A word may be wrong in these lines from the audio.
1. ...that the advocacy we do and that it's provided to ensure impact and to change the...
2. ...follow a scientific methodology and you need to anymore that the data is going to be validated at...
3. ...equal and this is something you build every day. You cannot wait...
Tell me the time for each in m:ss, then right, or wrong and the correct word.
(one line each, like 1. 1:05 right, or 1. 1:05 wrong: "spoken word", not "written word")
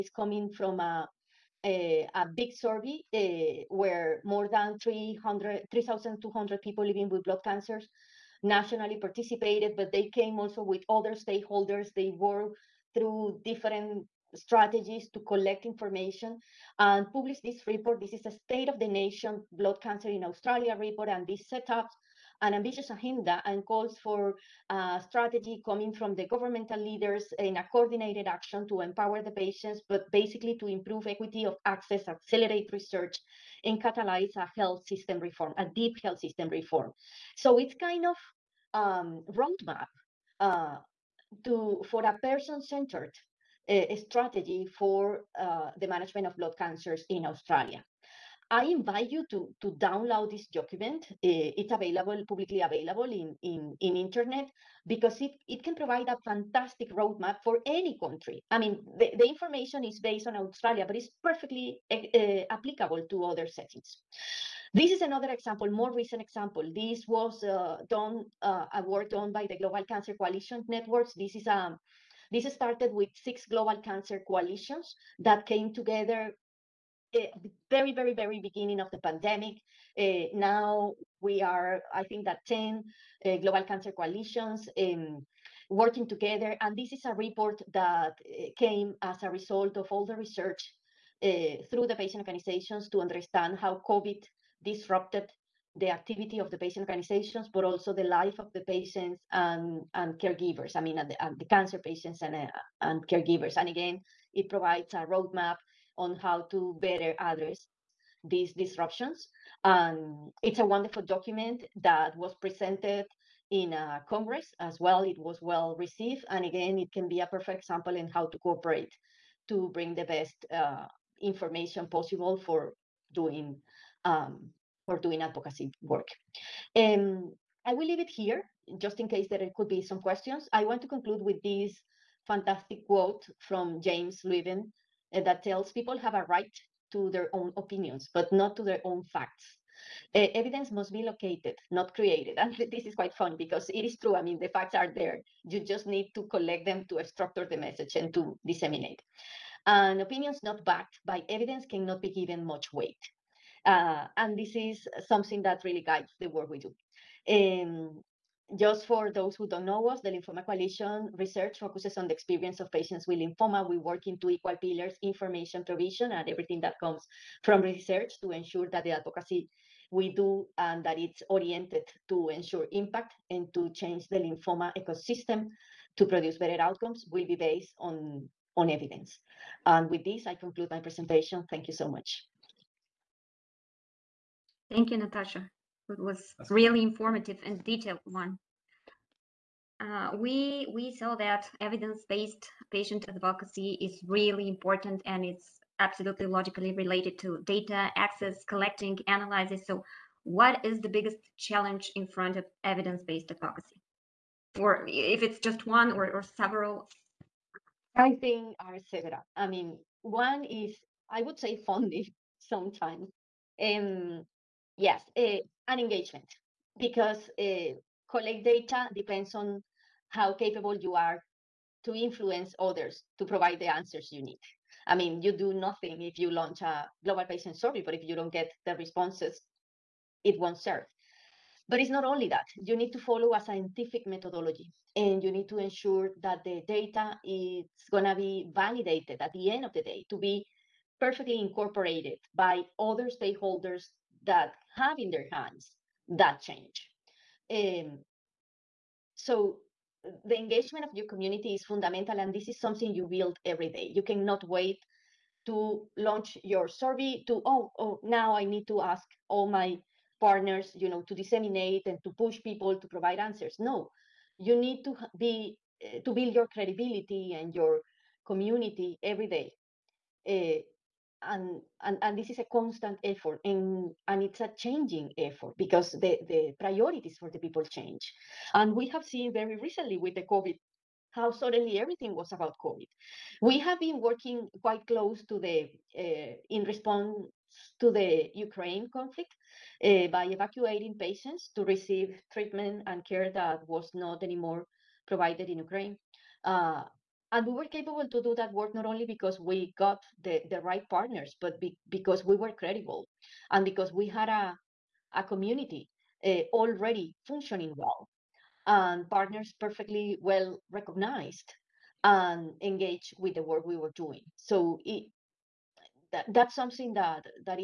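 1. 2:48 wrong: "oriented", not "provided"
2. 3:52 wrong: "ensure", not "anymore"
3. 4:11 wrong: "fundamental", not "equal".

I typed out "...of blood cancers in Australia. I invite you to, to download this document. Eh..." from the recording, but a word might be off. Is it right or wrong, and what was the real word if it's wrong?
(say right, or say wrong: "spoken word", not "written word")
right.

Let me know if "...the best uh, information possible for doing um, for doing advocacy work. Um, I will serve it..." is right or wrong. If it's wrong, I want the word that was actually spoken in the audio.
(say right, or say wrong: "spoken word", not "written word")
wrong: "leave", not "serve".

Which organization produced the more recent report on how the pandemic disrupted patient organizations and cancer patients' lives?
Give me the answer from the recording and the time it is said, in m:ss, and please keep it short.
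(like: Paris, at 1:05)
Global Cancer Coalition Networks, at 1:09.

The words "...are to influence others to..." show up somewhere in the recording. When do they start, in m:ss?
3:40.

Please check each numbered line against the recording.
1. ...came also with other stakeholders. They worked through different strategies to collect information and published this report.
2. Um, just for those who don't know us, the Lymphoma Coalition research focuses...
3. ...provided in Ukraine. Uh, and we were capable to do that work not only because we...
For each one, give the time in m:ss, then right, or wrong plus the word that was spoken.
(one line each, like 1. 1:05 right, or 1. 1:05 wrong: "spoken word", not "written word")
1. 0:10 right
2. 2:37 right
3. 4:55 right.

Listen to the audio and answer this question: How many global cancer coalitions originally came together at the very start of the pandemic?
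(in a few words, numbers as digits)
6.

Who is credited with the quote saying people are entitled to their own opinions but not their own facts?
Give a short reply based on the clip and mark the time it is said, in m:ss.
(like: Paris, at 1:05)
James Levin, at 2:13.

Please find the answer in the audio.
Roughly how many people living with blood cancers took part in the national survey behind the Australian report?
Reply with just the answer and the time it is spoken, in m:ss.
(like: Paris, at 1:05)
3,200, at 0:04.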